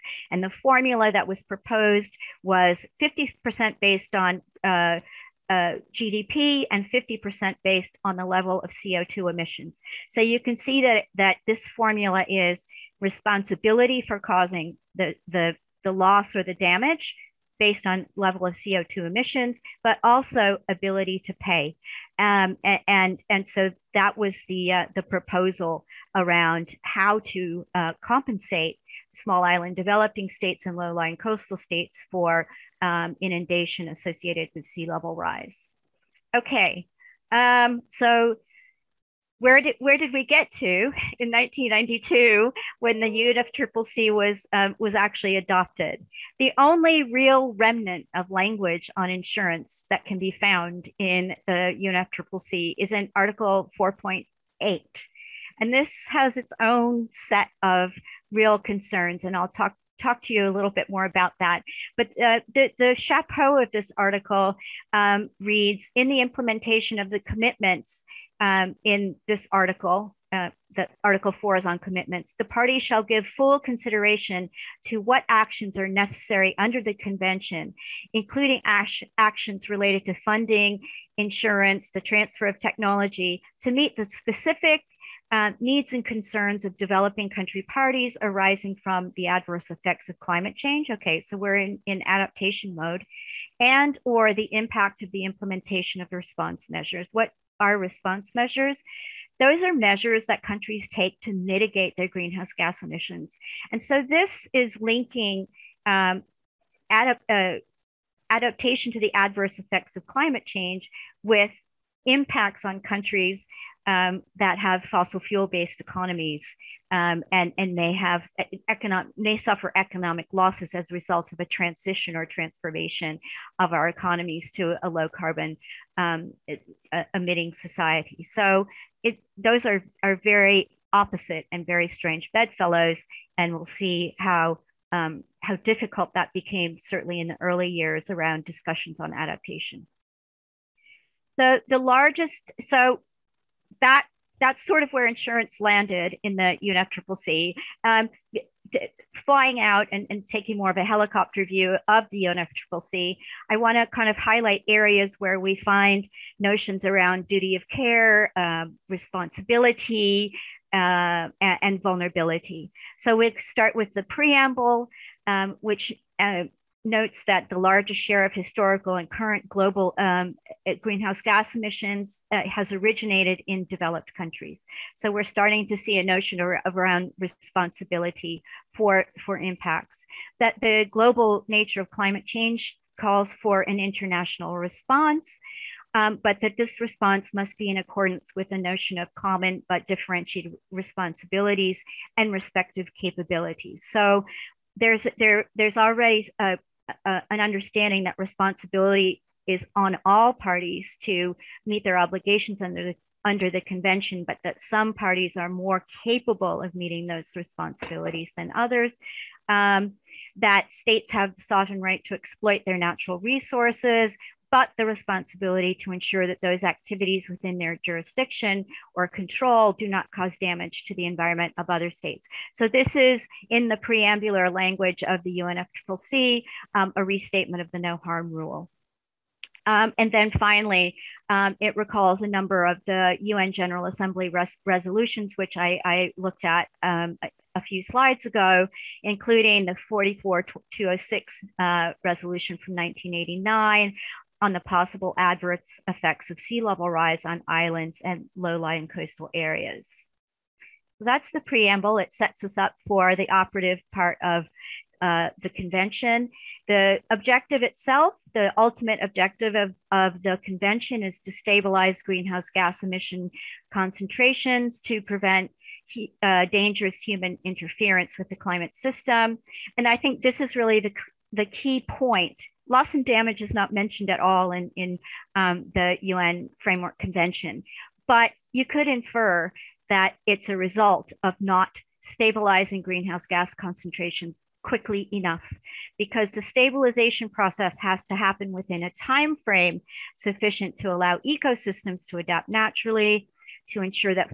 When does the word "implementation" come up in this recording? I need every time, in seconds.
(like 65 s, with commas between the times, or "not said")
66 s, 95 s.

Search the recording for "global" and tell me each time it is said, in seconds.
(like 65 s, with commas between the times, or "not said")
169 s, 180 s.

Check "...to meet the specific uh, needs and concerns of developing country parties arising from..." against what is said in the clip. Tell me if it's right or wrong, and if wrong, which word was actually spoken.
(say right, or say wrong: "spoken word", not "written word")
right.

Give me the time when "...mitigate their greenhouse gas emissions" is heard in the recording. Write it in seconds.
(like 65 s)
101 s.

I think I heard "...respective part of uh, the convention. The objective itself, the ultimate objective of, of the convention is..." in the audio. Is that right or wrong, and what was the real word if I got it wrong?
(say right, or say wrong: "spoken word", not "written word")
wrong: "operative", not "respective".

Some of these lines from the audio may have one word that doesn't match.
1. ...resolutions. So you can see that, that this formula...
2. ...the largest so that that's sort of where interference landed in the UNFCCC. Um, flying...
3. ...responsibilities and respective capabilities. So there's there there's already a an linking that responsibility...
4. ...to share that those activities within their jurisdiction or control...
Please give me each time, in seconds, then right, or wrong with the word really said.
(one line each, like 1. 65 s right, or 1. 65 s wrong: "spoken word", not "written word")
1. 9 s wrong: "emissions", not "resolutions"
2. 141 s wrong: "insurance", not "interference"
3. 190 s wrong: "understanding", not "linking"
4. 215 s wrong: "ensure", not "share".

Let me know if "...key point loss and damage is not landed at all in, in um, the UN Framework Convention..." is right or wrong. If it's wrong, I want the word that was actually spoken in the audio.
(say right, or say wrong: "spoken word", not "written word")
wrong: "mentioned", not "landed".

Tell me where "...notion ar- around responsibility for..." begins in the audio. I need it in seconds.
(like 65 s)
176 s.